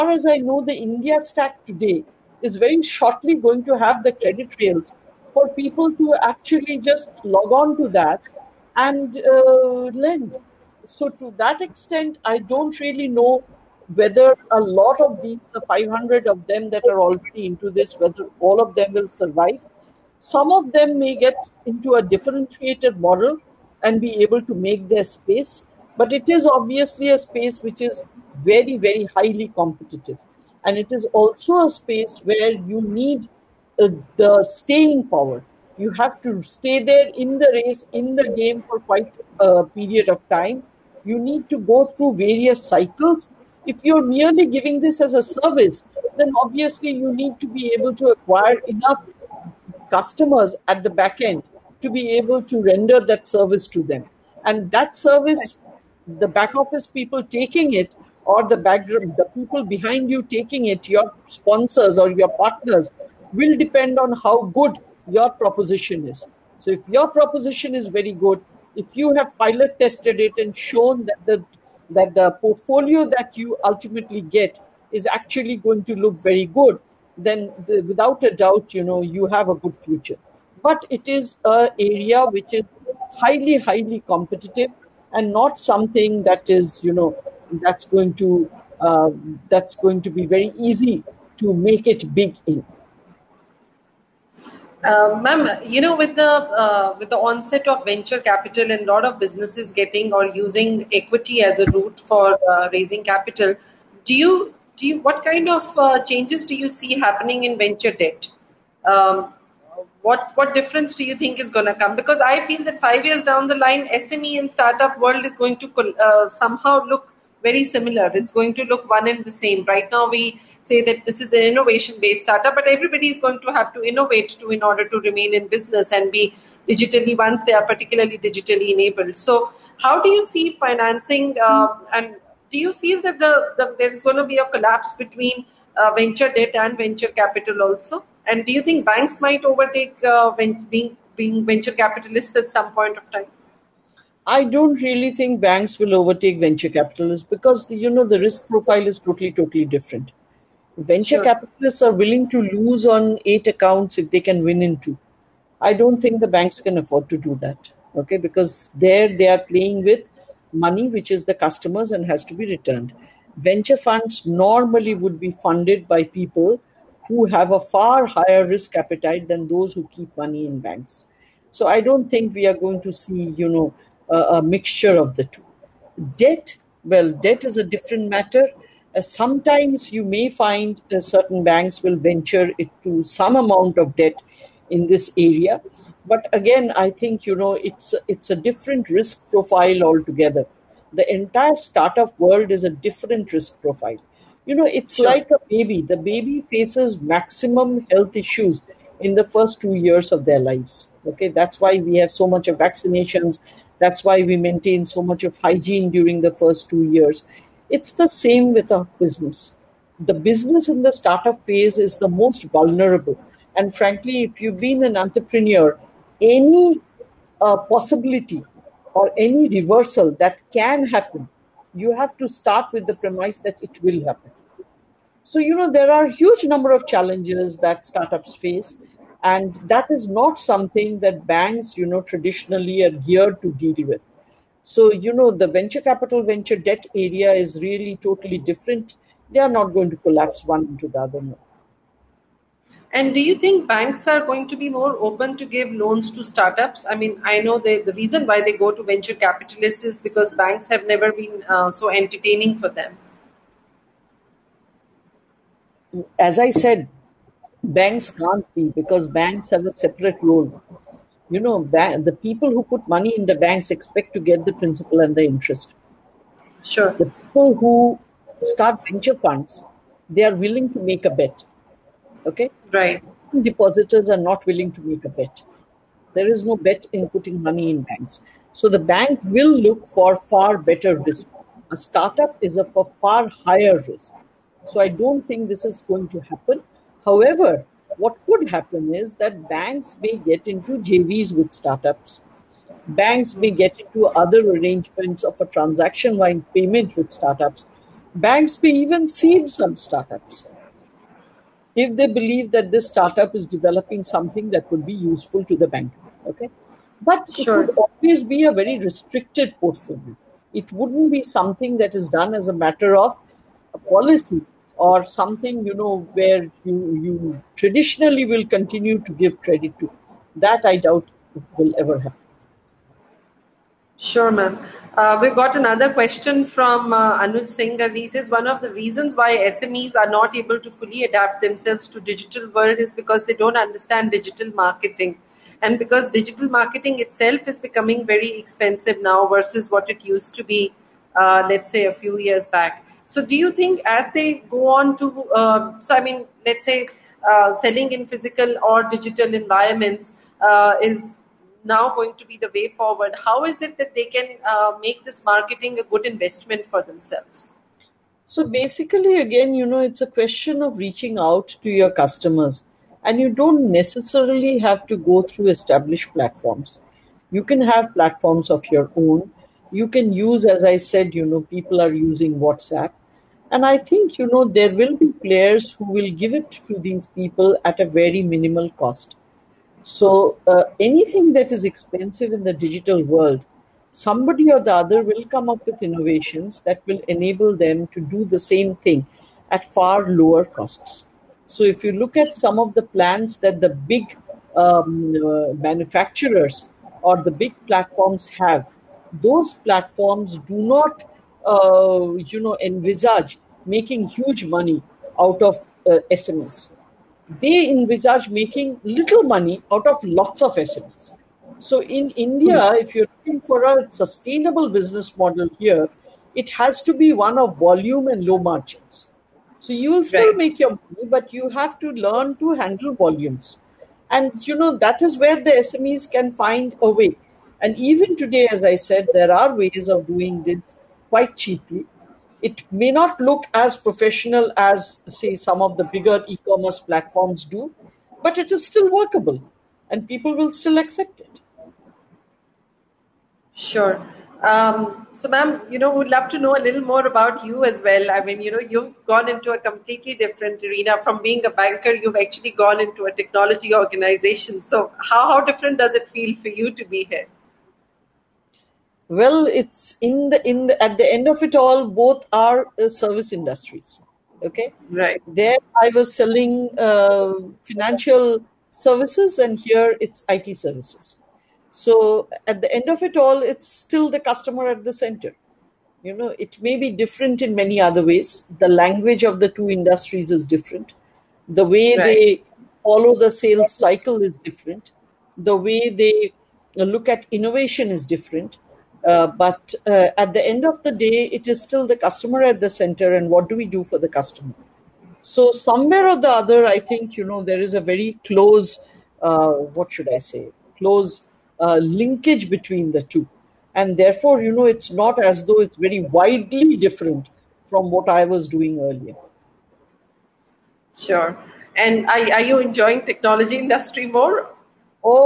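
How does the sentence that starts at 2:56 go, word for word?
Debt, well, debt is a different matter.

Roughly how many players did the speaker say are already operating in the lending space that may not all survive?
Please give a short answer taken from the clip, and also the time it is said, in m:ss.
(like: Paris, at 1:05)
500, at 0:15.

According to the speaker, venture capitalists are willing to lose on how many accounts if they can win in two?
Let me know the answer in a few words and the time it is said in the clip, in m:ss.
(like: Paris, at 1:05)
8, at 2:33.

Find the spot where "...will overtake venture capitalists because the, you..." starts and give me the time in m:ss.
2:25.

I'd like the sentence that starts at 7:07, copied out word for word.
And even today, as I said, there are ways of doing this quite cheaply.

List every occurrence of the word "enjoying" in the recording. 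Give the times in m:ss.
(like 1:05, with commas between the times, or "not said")
8:32.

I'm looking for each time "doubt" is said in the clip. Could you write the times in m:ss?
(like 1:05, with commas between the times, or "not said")
1:18, 5:20.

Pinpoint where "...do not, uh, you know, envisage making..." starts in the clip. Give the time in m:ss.
6:40.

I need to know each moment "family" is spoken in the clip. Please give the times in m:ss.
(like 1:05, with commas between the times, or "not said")
not said.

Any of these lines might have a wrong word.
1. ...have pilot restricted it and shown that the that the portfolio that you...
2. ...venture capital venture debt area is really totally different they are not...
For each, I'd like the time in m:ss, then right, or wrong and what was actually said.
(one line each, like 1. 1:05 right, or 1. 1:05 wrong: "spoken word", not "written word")
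1. 1:09 wrong: "tested", not "restricted"
2. 3:55 right.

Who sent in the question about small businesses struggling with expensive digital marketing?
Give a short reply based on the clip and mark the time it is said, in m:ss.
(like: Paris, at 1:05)
Anuj Singh, at 5:27.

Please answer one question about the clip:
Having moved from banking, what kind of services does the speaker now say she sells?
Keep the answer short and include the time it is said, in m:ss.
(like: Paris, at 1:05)
IT services, at 7:50.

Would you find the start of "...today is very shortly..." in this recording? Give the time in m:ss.
0:01.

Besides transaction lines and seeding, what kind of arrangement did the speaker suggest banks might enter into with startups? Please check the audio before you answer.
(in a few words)
JVs.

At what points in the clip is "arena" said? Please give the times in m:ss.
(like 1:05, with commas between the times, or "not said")
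7:30.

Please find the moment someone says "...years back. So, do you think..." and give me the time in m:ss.
5:42.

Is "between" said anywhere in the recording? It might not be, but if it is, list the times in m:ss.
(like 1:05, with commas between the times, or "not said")
2:15, 8:22.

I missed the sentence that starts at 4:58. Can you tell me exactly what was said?
Banks may even seed some startups if they believe that this startup is developing something that could be useful to the bank.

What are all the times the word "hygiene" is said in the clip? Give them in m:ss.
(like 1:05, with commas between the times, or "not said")
3:25.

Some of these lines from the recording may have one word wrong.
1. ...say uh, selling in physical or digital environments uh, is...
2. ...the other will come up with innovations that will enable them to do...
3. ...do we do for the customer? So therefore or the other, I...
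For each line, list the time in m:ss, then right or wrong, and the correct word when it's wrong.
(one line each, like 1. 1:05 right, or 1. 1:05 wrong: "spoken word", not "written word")
1. 5:46 right
2. 6:24 right
3. 8:13 wrong: "somewhere", not "therefore".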